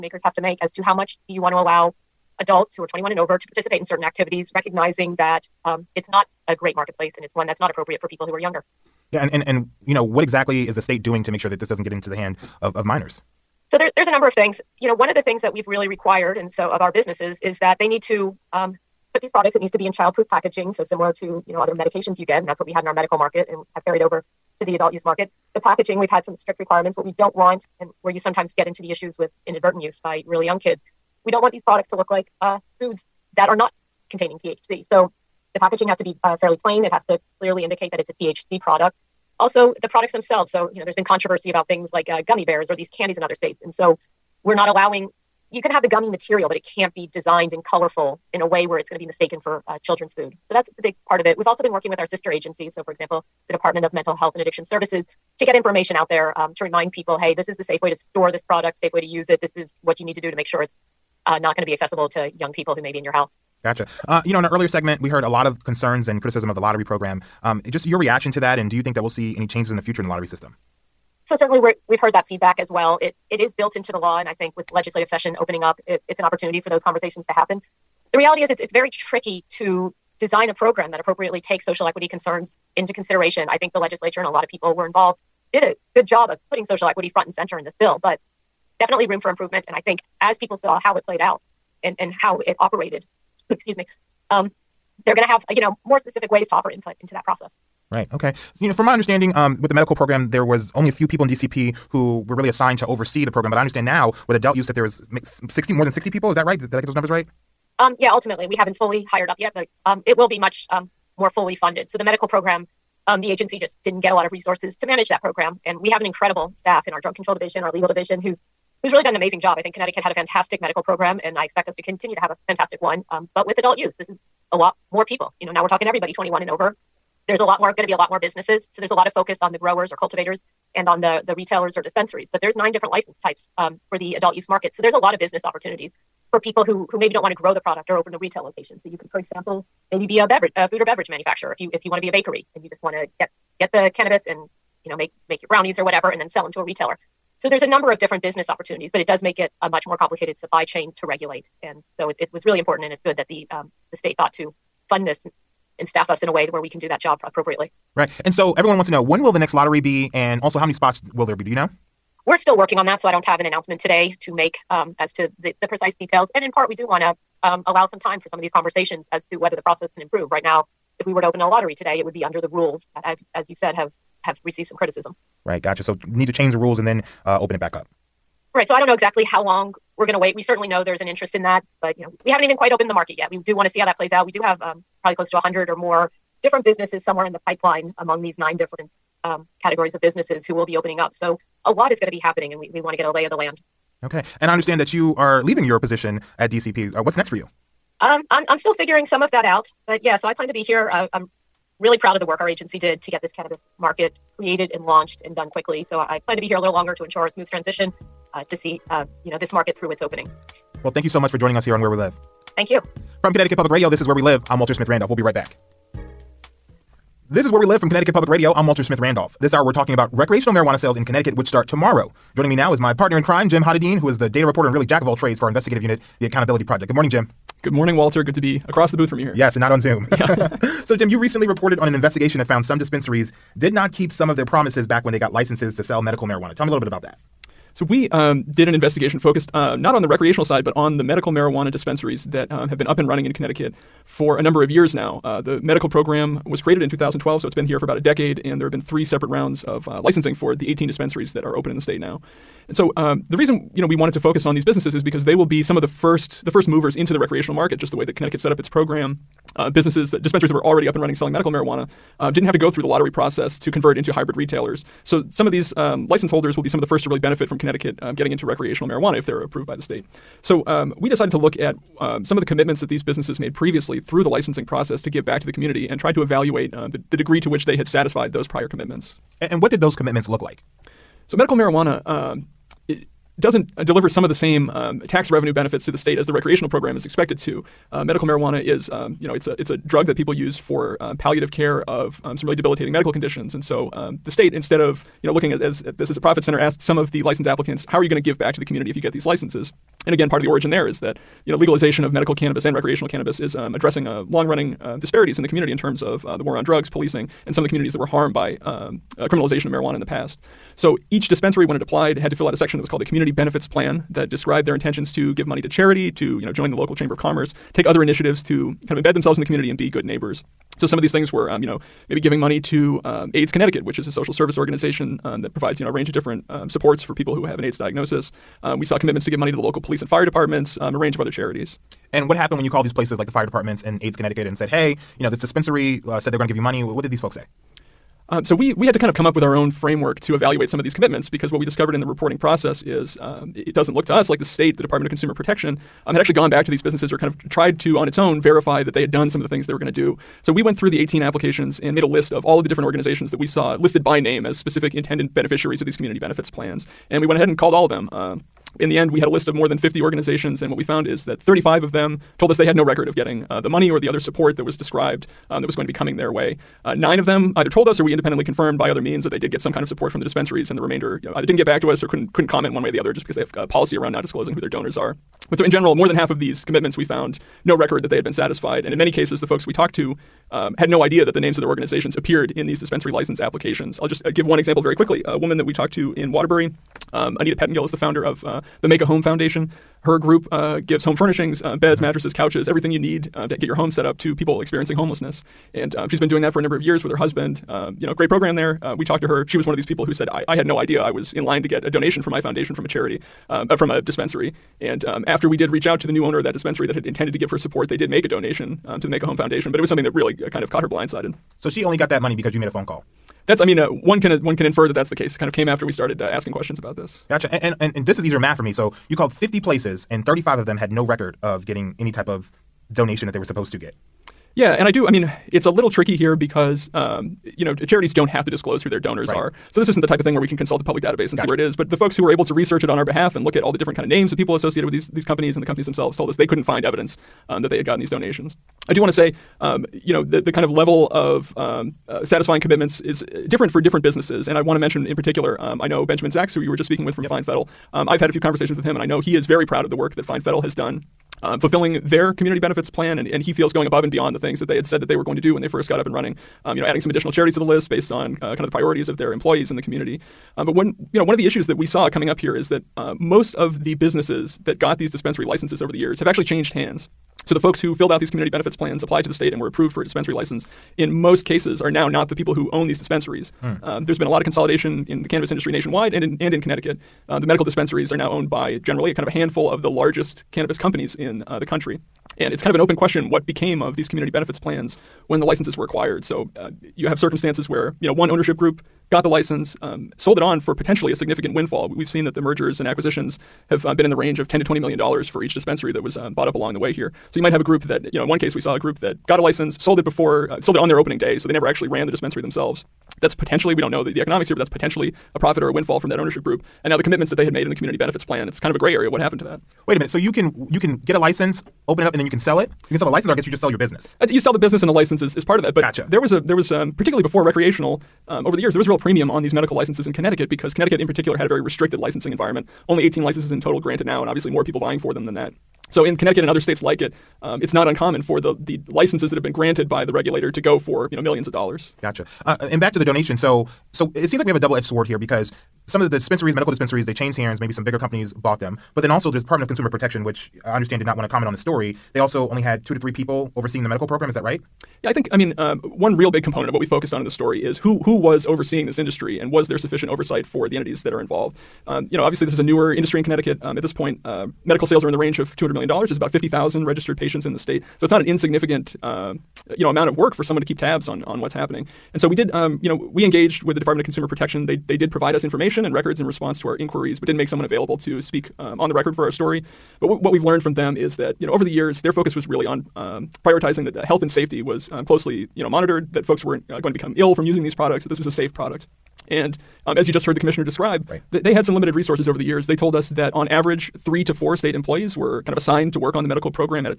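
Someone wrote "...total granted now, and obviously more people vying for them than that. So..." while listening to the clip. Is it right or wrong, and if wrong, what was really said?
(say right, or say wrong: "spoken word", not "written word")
right.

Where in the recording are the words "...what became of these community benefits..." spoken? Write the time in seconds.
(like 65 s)
483 s.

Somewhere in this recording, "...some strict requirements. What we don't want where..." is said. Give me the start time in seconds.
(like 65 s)
26 s.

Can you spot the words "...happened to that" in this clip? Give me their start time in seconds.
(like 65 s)
509 s.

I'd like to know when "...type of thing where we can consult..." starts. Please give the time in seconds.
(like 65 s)
430 s.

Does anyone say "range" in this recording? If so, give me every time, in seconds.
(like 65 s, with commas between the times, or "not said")
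325 s, 330 s, 494 s, 555 s.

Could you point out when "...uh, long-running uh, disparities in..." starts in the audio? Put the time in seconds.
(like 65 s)
304 s.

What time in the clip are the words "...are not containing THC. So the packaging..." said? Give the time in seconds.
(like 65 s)
33 s.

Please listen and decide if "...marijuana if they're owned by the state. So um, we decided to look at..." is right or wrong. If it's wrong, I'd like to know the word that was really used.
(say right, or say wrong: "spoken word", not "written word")
wrong: "approved", not "owned".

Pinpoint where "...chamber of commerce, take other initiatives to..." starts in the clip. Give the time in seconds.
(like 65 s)
316 s.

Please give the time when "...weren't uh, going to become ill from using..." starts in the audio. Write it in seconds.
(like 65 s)
576 s.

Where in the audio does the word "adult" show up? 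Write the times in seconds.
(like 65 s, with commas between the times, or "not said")
2 s, 24 s, 104 s, 123 s, 134 s.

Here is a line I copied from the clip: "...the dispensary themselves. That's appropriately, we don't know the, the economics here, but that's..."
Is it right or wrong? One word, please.
wrong.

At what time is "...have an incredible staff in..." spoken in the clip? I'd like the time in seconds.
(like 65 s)
115 s.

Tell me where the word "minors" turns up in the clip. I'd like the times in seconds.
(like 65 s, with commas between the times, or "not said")
12 s.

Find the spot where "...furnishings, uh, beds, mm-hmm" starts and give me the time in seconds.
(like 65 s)
391 s.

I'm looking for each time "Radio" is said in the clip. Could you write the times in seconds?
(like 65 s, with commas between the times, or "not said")
213 s, 218 s.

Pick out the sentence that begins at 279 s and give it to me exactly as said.
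And, and what did those commitments look like?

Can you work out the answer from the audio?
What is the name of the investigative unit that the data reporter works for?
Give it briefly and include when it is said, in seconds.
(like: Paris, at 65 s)
The Accountability Project, at 226 s.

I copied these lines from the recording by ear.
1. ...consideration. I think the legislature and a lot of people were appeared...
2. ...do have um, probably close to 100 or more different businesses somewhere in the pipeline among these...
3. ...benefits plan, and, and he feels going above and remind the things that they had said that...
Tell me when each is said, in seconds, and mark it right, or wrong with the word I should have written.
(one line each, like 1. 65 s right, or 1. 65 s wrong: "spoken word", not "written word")
1. 82 s wrong: "involved", not "appeared"
2. 184 s right
3. 452 s wrong: "beyond", not "remind".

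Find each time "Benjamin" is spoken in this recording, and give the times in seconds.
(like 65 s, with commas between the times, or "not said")
446 s.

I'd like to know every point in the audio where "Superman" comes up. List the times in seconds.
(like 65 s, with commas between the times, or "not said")
not said.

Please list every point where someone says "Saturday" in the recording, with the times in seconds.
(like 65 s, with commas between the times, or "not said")
not said.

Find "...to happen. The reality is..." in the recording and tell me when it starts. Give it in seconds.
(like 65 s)
77 s.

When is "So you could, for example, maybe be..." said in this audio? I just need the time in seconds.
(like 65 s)
138 s.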